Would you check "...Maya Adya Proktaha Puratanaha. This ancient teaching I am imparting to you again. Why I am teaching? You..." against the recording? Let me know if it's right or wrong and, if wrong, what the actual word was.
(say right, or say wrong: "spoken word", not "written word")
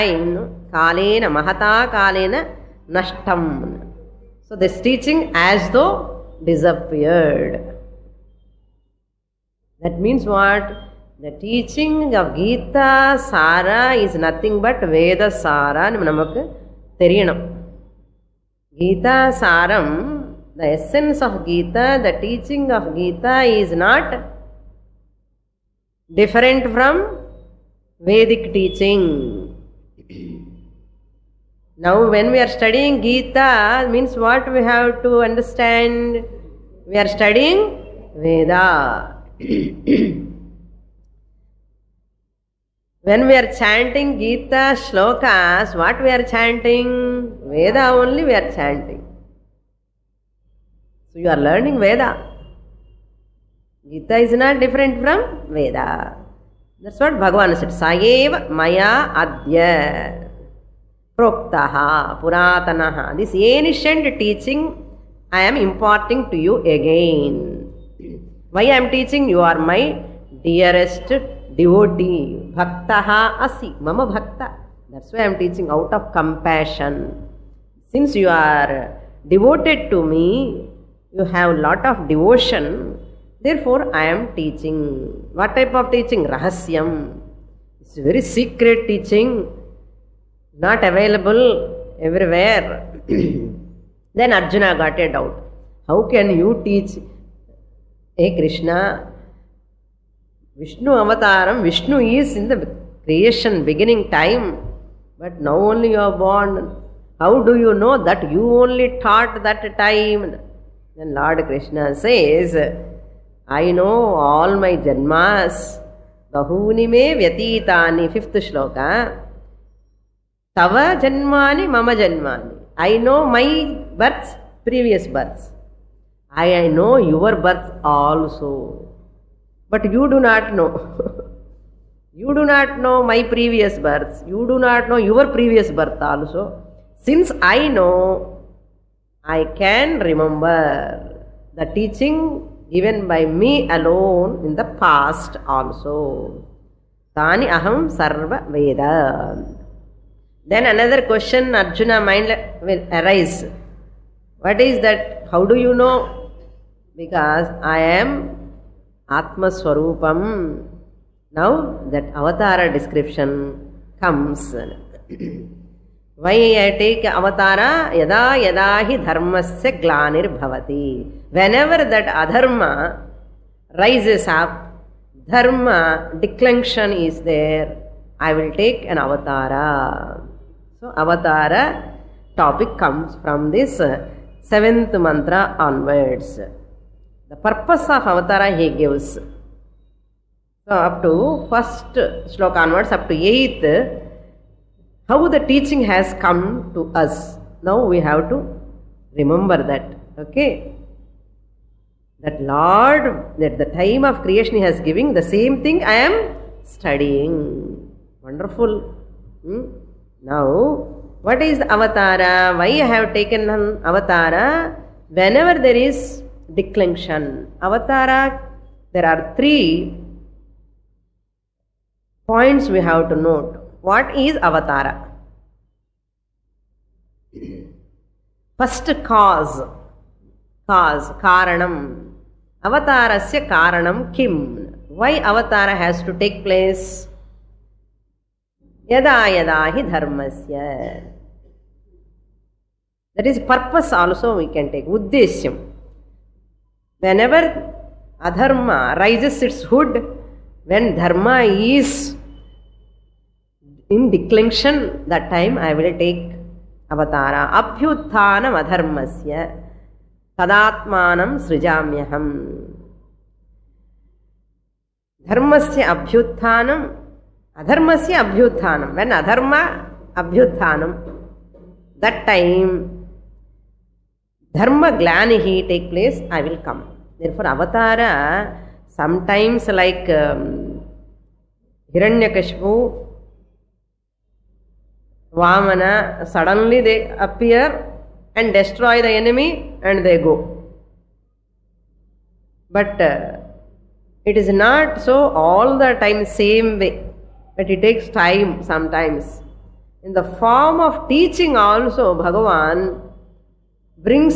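right.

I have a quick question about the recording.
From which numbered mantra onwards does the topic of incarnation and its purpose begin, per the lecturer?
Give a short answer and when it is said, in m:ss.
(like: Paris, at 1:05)
seventh, at 3:04.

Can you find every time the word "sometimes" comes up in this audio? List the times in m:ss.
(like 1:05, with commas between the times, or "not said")
4:38, 4:58.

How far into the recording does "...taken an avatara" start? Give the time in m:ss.
3:33.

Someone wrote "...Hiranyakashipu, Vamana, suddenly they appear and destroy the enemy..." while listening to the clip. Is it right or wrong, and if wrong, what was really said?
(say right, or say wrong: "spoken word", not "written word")
right.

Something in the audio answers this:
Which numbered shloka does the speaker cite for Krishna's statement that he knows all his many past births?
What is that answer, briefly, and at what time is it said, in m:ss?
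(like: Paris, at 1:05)
fifth, at 1:58.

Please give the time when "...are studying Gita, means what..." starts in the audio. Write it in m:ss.
0:32.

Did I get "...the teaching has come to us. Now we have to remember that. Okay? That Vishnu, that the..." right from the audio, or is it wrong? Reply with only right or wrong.
wrong.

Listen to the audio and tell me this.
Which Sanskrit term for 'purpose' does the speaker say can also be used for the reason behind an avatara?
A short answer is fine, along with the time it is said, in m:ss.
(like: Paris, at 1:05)
uddeshyam, at 4:04.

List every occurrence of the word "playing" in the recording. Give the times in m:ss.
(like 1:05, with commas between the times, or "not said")
not said.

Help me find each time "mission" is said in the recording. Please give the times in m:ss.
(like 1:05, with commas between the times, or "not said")
not said.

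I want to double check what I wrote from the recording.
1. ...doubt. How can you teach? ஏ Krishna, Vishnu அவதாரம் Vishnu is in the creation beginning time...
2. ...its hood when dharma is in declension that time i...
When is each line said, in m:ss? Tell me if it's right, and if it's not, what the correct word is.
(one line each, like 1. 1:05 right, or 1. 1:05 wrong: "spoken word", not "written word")
1. 1:35 right
2. 4:09 right.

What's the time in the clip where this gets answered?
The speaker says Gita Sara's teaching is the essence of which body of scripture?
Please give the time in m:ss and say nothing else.
0:14.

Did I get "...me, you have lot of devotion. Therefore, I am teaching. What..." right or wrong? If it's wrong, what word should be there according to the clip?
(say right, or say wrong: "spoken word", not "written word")
right.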